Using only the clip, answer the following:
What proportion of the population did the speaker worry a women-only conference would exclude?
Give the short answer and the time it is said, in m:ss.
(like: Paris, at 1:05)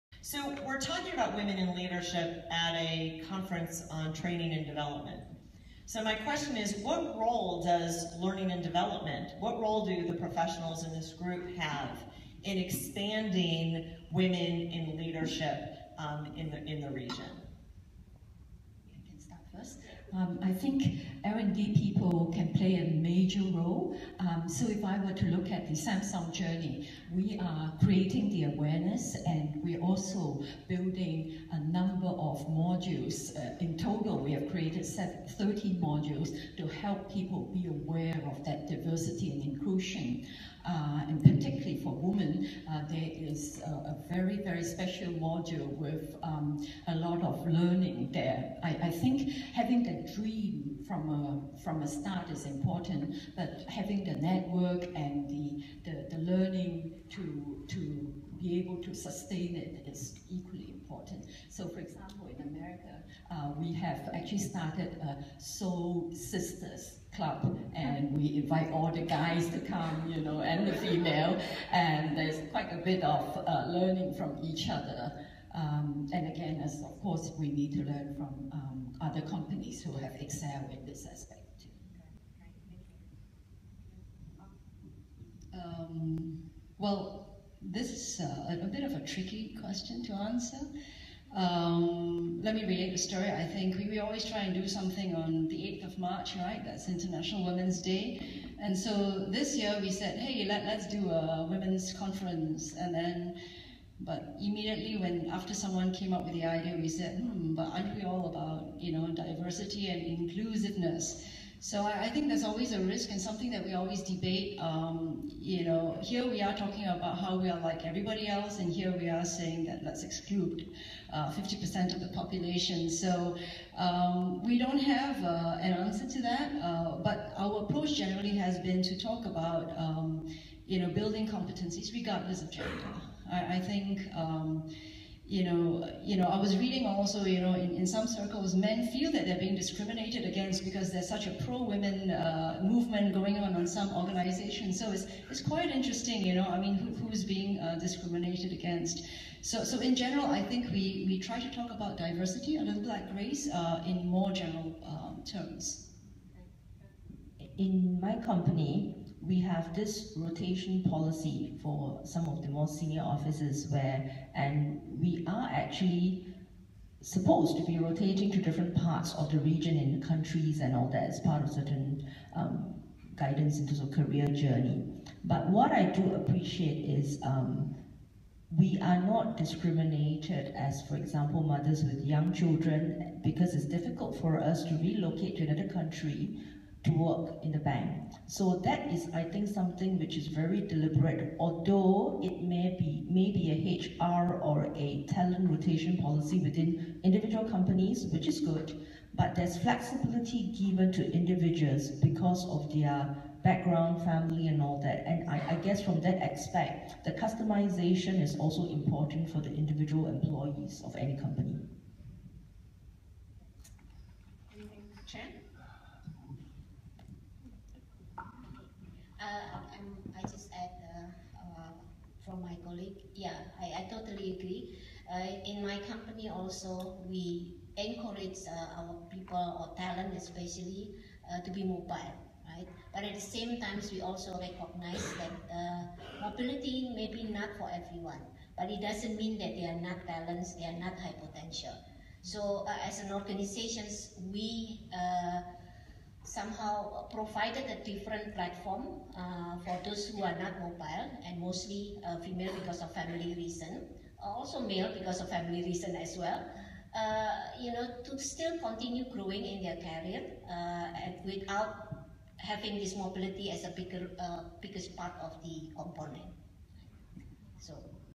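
50%, at 2:01.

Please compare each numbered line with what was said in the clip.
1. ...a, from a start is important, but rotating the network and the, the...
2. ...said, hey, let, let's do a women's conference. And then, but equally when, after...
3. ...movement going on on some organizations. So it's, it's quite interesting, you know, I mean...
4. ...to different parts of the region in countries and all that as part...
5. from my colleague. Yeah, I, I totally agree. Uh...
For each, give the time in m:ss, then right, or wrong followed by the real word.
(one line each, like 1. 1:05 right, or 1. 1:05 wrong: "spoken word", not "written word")
1. 0:51 wrong: "having", not "rotating"
2. 1:39 wrong: "immediately", not "equally"
3. 2:22 right
4. 2:48 right
5. 3:42 right.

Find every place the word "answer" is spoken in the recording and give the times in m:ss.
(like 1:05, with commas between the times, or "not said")
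1:30, 2:05.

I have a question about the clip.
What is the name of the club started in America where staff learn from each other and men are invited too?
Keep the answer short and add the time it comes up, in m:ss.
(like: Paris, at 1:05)
Soul Sisters club, at 1:05.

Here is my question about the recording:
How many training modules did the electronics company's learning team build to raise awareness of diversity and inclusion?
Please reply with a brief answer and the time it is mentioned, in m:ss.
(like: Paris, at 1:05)
13, at 0:34.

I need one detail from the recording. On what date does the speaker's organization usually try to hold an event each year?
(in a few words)
8th of March.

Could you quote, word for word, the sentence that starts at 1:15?
Um, and again, as of course, we need to learn from um, other companies who have excelled in this aspect too.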